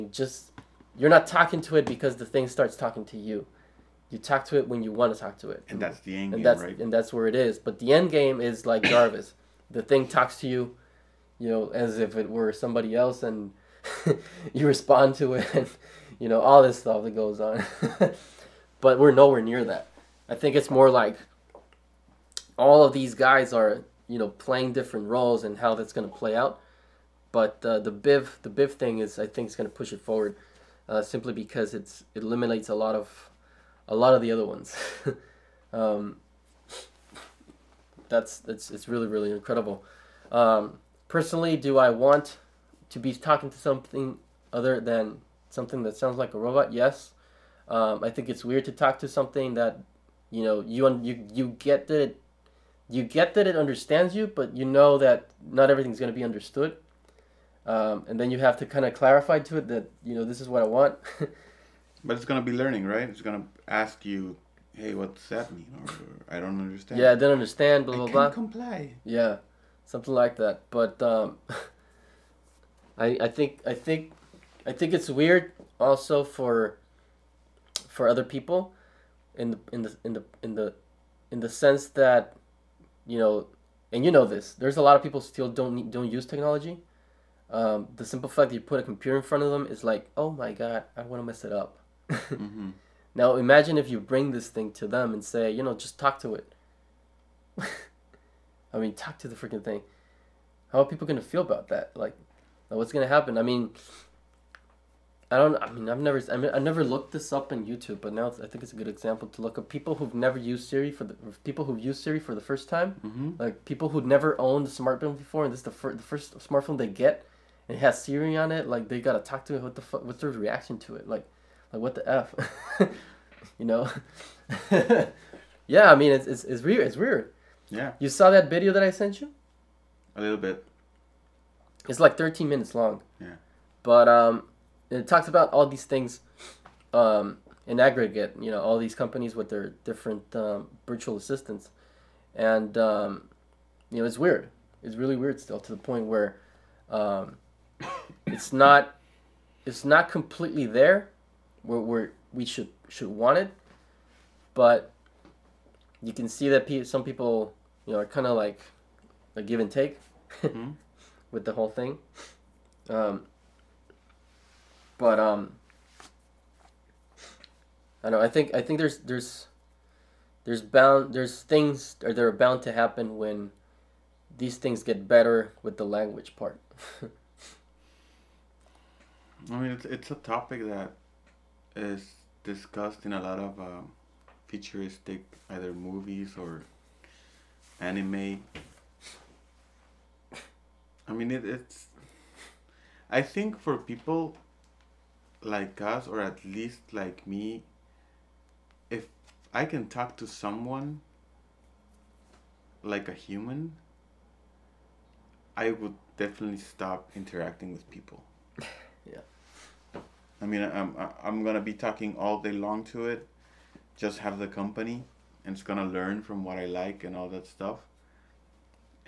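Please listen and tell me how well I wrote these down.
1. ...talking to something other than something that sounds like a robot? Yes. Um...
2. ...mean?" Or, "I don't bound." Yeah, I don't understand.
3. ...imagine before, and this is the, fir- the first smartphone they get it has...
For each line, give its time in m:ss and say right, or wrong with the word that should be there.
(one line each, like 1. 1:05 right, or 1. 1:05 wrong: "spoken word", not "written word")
1. 0:43 right
2. 1:05 wrong: "understand", not "bound"
3. 1:54 wrong: "smartphone", not "imagine".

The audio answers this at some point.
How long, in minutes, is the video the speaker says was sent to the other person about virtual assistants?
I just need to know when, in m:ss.
2:12.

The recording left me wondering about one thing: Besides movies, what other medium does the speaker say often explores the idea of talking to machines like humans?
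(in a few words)
Anime.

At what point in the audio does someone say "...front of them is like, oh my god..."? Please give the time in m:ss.
1:29.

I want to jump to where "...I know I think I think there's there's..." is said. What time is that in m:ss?
2:48.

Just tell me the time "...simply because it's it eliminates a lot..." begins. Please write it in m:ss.
0:31.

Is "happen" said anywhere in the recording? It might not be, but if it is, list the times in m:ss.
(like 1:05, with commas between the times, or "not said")
1:43, 2:52.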